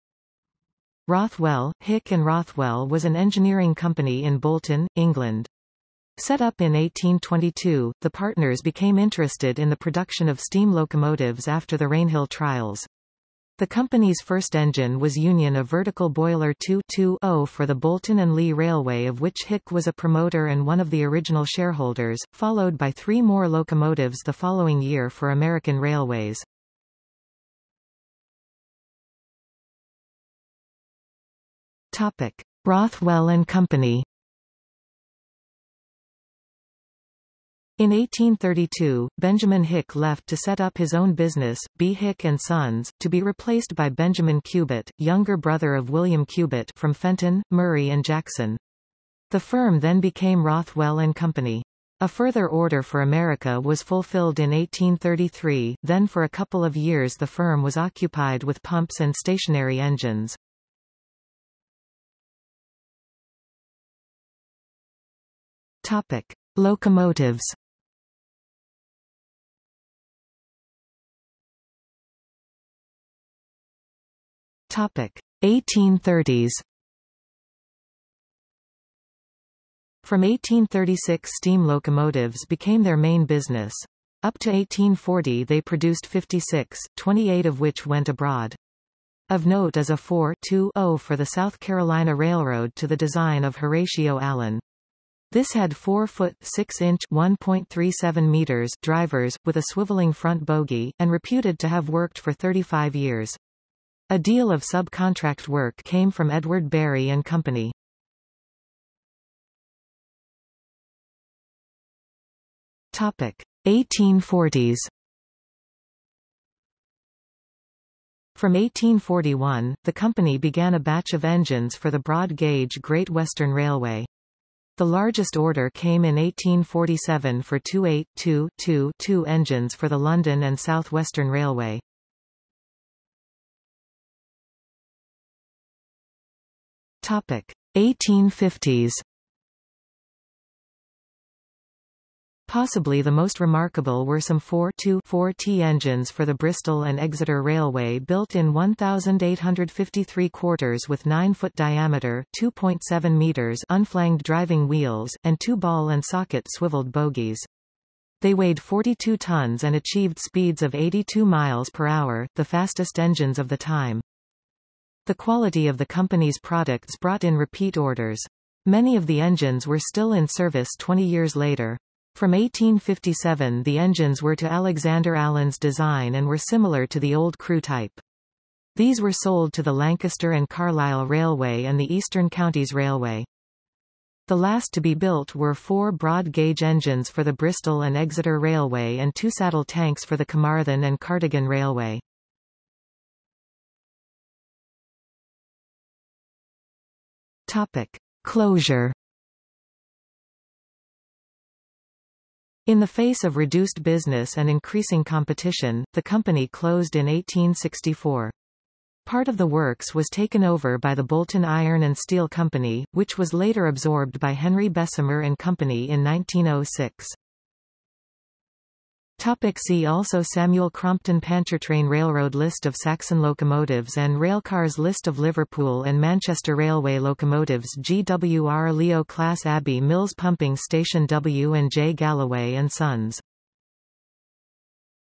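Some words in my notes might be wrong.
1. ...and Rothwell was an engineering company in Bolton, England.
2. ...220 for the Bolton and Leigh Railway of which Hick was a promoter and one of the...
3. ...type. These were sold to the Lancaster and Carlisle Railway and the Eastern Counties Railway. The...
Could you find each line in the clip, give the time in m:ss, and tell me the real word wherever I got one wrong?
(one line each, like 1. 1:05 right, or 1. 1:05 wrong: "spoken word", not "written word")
1. 0:02 right
2. 0:16 right
3. 2:57 right.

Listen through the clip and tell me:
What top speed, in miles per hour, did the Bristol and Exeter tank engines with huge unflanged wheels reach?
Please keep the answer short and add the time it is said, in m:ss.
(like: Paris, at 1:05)
82, at 2:40.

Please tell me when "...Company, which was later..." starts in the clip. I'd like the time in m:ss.
3:32.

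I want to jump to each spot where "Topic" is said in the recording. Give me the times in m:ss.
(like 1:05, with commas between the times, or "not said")
0:32, 1:05, 1:14, 1:52, 2:17, 3:17, 3:39.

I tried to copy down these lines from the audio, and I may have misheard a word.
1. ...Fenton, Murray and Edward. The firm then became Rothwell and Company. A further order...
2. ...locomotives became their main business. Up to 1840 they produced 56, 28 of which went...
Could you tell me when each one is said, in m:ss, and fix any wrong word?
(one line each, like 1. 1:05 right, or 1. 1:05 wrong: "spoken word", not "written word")
1. 0:46 wrong: "Jackson", not "Edward"
2. 1:21 right.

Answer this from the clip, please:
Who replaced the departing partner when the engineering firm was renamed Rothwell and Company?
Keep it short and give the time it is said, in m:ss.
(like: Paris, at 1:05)
Benjamin Cubitt, at 0:43.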